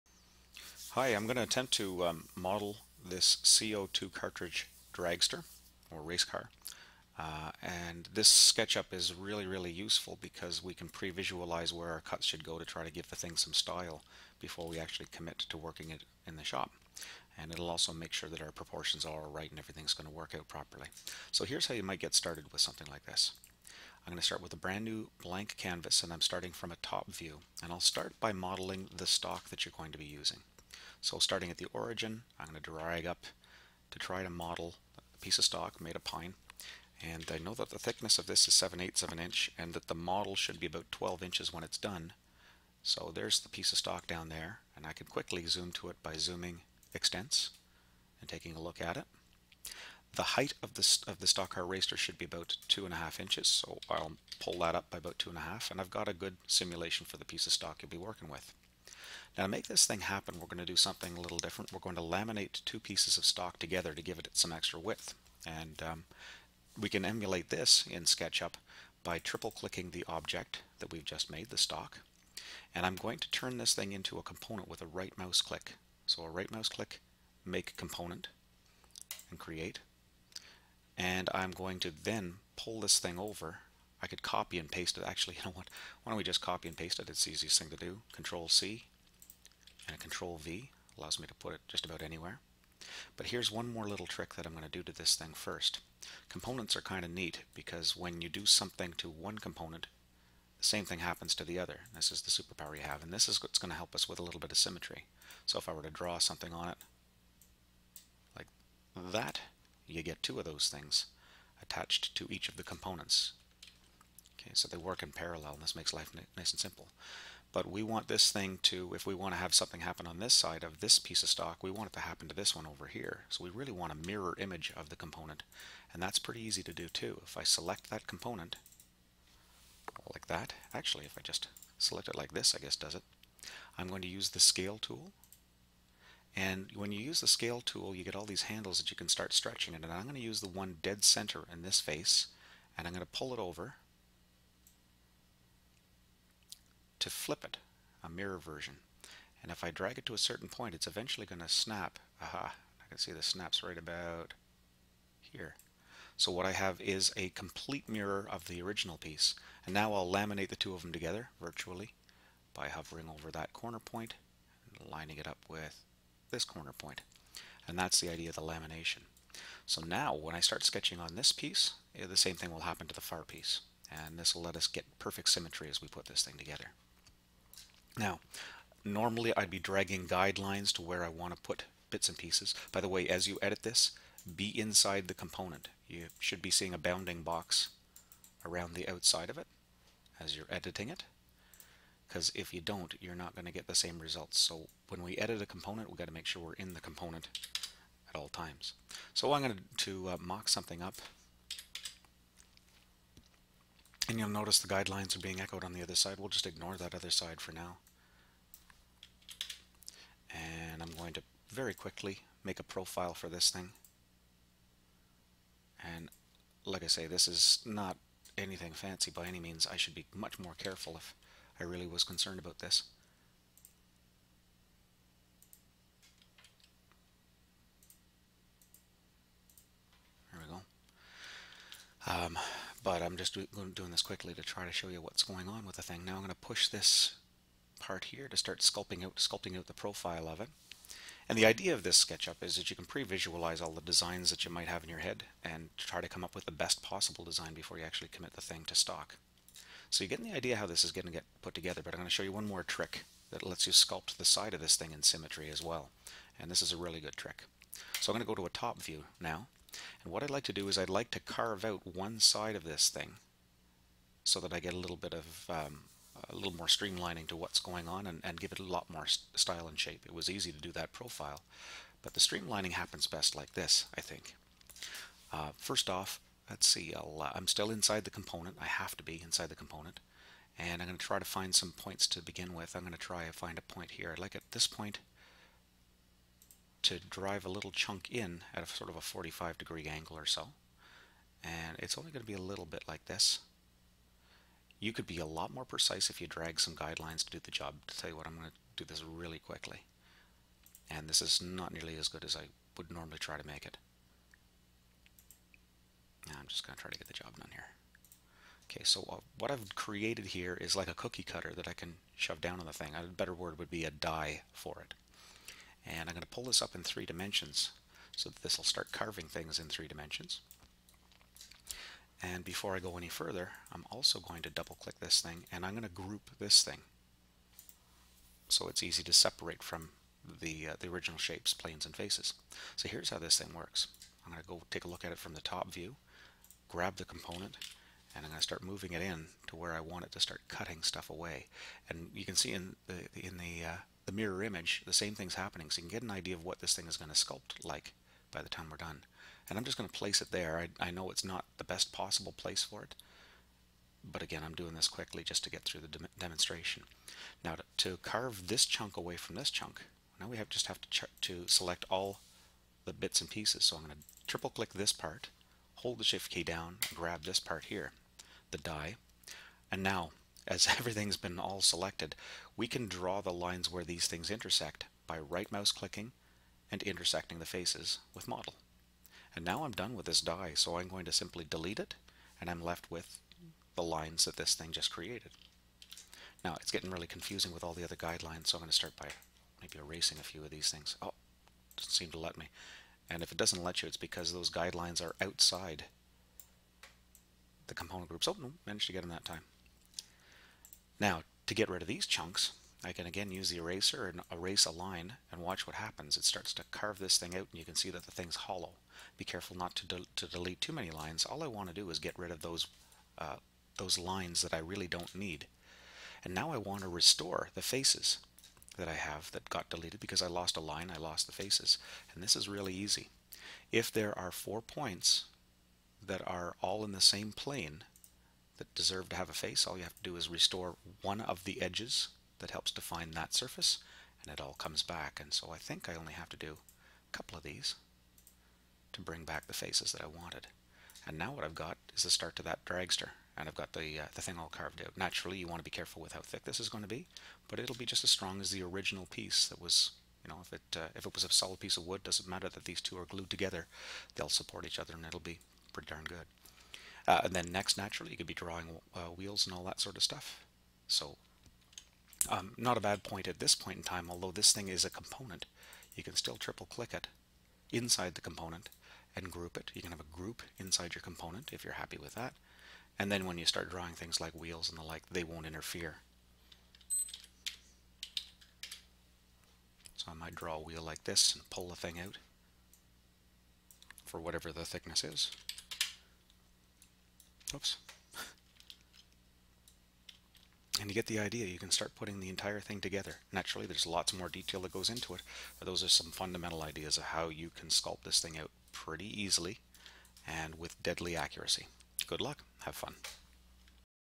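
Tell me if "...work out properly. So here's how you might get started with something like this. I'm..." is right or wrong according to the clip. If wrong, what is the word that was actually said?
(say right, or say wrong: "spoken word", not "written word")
right.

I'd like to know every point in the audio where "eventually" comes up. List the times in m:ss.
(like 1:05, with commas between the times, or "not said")
2:30.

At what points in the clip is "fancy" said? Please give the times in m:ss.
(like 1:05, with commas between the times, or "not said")
3:38.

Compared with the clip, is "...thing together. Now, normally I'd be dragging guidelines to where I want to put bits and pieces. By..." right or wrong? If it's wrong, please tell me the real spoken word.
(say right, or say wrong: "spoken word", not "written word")
right.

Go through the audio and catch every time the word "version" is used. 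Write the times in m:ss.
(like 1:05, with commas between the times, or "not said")
2:28.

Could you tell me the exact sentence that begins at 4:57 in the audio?
To tell you what, I'm going to do this really quickly.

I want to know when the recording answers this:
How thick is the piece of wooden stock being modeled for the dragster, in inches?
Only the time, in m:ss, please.
0:38.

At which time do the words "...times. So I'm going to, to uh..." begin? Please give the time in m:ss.
3:18.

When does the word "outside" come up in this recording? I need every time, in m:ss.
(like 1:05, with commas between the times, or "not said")
3:08, 6:35.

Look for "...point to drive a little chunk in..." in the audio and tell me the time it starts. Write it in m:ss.
4:44.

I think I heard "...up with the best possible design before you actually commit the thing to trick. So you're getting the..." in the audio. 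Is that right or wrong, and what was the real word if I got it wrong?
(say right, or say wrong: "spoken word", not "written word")
wrong: "stock", not "trick".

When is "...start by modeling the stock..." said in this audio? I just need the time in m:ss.
0:27.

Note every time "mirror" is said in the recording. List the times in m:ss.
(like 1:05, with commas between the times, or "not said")
2:04, 2:28, 2:37, 5:44.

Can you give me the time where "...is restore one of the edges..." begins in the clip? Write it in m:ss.
7:10.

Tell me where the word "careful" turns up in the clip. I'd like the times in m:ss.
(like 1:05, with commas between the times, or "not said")
3:40, 6:49, 7:25.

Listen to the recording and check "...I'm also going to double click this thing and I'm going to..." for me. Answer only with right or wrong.
right.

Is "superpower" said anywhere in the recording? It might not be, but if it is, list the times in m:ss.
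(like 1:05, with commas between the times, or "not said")
1:42.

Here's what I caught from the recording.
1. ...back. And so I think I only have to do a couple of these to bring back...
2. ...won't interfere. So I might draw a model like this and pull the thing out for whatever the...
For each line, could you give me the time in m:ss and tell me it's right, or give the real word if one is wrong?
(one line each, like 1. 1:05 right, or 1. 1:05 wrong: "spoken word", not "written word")
1. 7:14 right
2. 7:55 wrong: "wheel", not "model".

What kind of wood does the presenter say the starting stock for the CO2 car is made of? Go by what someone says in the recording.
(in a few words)
pine.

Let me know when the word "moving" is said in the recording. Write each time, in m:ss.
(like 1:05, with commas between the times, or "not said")
5:38.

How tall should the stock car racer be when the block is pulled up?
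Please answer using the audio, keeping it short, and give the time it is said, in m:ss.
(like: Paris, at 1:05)
2.5 inches, at 0:52.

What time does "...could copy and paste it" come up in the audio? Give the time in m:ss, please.
1:24.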